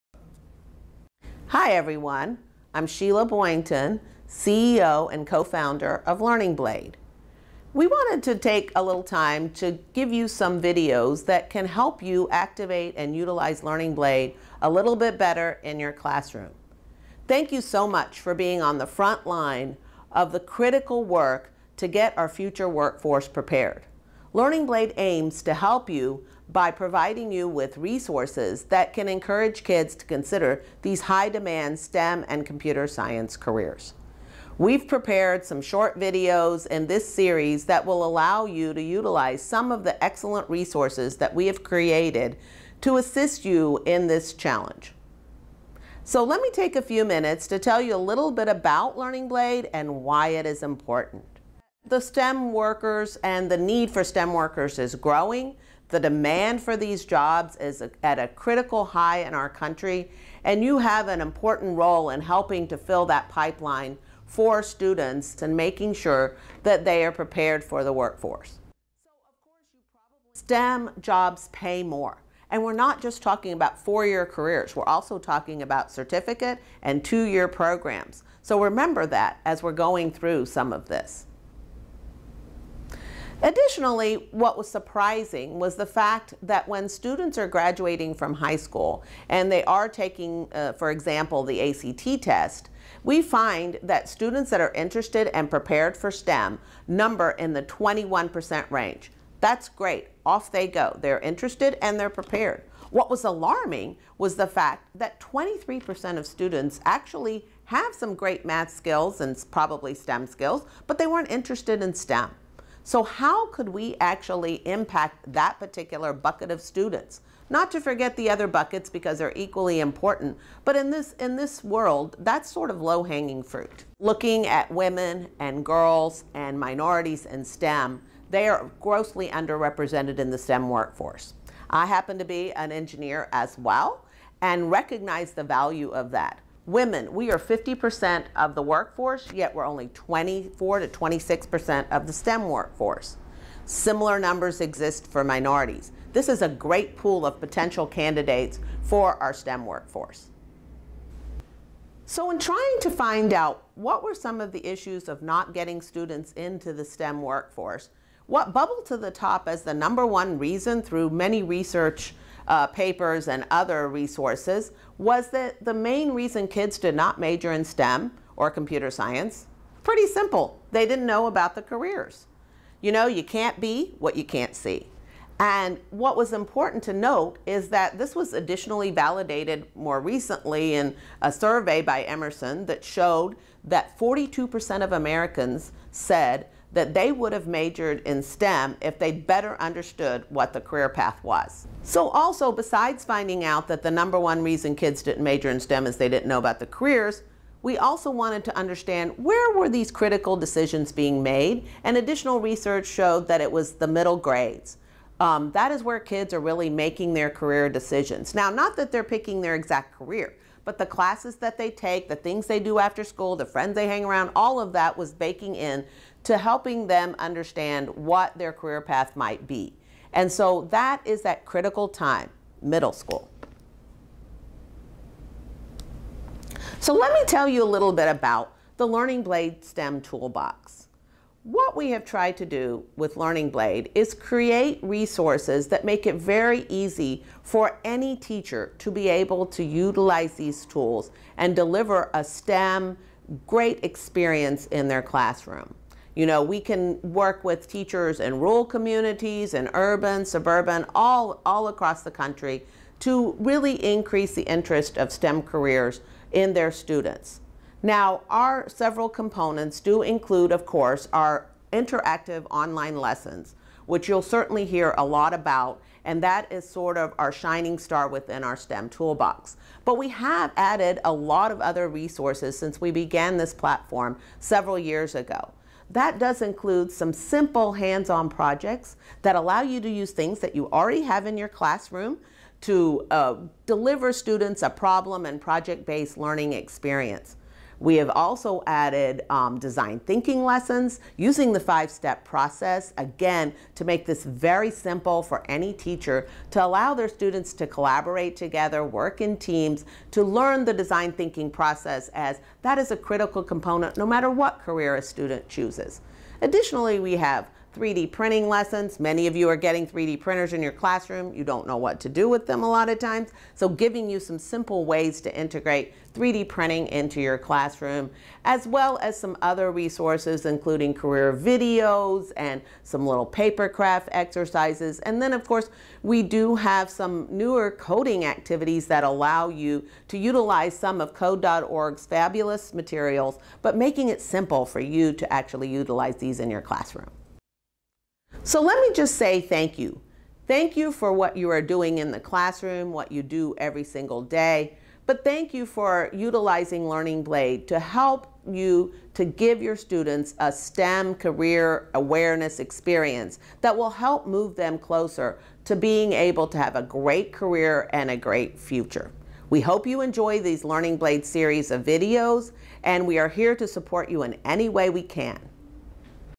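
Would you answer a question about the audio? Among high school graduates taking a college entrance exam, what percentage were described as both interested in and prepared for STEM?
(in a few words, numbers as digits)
21%.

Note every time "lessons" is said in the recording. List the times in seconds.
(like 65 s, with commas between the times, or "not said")
262 s, 290 s, 308 s.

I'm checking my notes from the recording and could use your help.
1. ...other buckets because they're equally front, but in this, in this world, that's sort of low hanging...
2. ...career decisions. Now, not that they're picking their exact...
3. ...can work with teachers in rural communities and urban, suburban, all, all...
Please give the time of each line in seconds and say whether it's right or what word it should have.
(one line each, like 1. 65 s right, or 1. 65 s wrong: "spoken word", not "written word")
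1. 118 s wrong: "important", not "front"
2. 207 s right
3. 246 s right.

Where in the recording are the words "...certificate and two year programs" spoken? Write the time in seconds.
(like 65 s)
75 s.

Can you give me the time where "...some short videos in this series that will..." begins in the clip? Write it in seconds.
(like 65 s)
35 s.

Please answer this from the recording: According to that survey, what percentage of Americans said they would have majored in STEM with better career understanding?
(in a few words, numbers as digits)
42%.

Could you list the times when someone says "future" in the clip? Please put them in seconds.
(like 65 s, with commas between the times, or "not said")
22 s, 358 s.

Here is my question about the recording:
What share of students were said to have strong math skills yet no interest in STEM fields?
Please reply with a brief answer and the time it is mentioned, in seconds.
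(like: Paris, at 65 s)
23%, at 105 s.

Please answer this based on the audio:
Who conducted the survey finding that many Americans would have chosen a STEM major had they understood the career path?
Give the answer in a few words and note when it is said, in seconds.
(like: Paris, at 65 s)
Emerson, at 182 s.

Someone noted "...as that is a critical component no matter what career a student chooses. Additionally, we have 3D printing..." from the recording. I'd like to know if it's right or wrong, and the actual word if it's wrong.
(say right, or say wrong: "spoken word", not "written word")
right.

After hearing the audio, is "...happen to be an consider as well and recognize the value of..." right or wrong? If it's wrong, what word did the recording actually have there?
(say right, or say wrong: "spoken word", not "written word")
wrong: "engineer", not "consider".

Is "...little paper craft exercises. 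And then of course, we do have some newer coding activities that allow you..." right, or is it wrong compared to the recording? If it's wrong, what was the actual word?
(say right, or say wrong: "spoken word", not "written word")
right.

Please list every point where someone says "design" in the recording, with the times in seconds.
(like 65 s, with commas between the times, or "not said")
289 s, 300 s.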